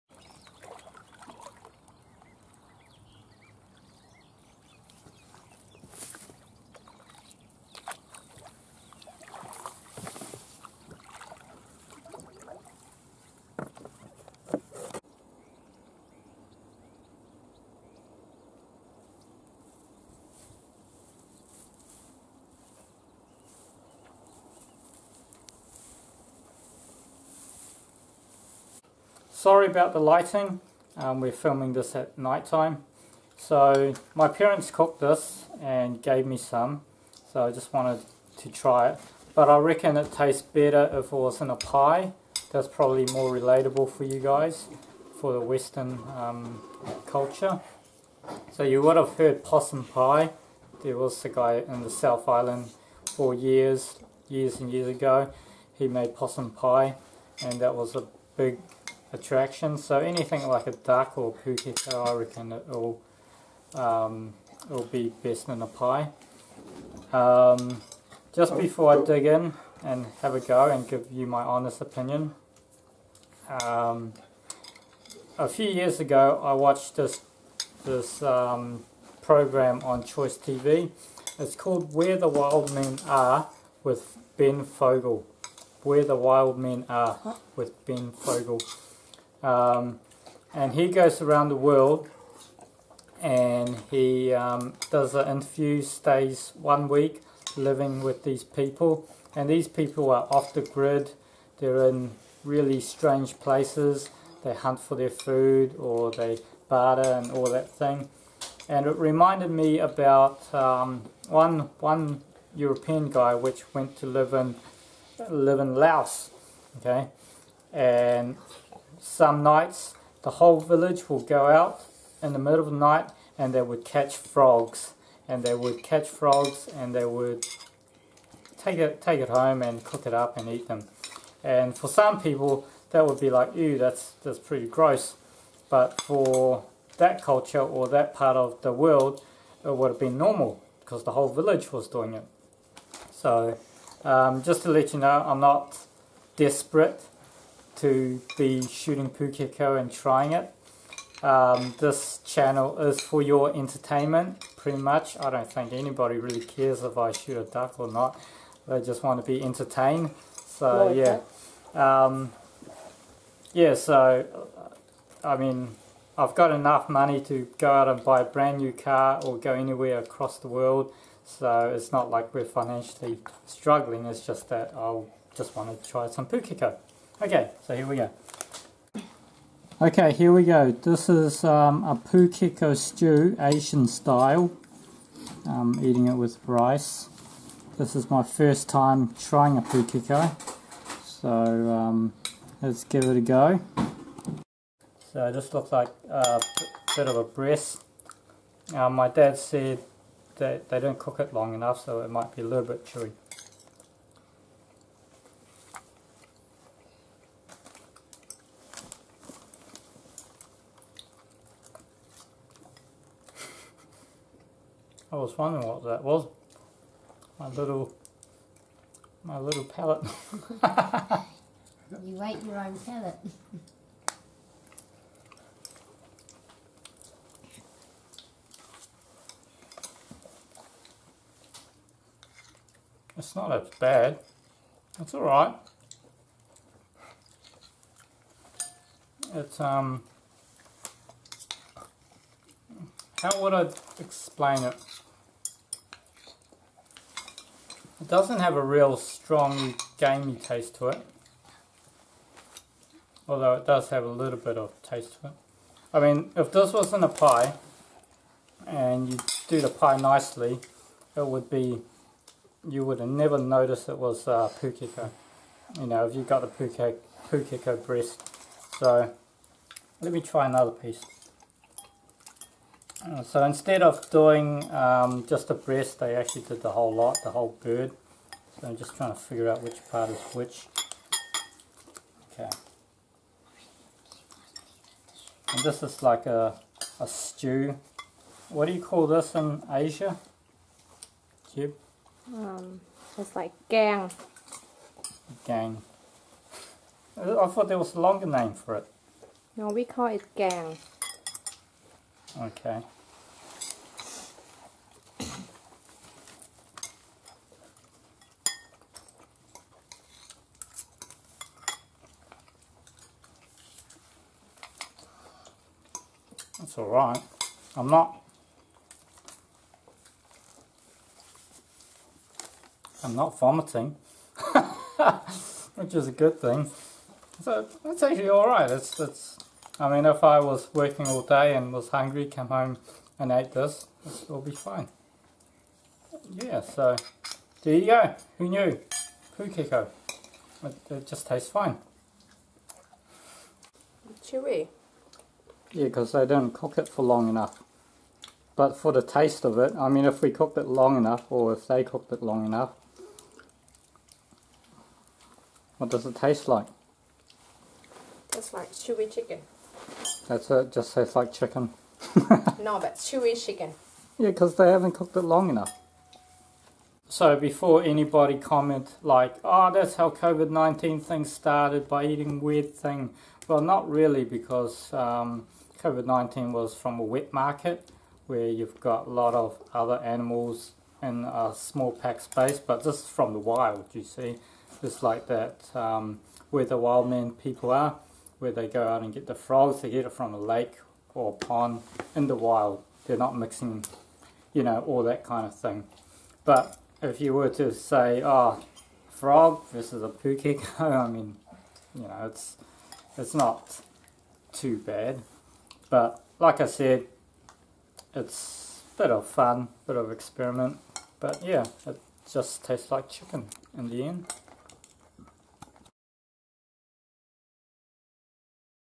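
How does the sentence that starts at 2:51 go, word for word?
So it's not like we're financially struggling.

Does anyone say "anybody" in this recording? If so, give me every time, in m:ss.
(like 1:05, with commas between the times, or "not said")
2:35, 6:07.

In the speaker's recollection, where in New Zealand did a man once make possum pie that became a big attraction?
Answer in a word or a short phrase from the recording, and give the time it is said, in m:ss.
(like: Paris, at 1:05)
South Island, at 0:51.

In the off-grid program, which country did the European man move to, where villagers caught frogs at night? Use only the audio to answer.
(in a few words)
Laos.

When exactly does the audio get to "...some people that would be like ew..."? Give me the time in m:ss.
2:11.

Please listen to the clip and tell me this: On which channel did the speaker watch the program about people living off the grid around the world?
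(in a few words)
Choice TV.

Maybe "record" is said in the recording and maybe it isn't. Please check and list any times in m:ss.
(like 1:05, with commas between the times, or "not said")
not said.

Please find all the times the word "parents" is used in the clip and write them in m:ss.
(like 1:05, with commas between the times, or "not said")
0:34.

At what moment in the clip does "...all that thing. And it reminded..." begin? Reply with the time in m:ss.
1:47.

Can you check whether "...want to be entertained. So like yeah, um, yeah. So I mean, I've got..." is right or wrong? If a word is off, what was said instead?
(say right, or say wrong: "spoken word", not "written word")
right.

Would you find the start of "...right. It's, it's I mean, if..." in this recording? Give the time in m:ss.
5:28.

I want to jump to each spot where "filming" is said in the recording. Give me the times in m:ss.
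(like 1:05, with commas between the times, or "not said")
0:31.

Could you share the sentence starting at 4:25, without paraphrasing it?
You know, if you got the pukeko, pukeko breast.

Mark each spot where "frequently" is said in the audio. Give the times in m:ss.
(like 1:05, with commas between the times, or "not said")
not said.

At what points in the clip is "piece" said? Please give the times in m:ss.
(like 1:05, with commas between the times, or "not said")
4:30.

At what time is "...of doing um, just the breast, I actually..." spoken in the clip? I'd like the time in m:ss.
4:33.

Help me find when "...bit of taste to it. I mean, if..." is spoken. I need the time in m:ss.
4:14.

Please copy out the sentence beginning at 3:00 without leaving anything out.
This is um, a pukeko stew, Asian style.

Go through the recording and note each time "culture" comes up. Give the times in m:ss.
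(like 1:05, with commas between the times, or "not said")
0:47, 2:17.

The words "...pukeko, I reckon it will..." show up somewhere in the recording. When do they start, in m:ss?
1:01.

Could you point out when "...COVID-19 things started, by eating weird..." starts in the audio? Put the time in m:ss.
6:10.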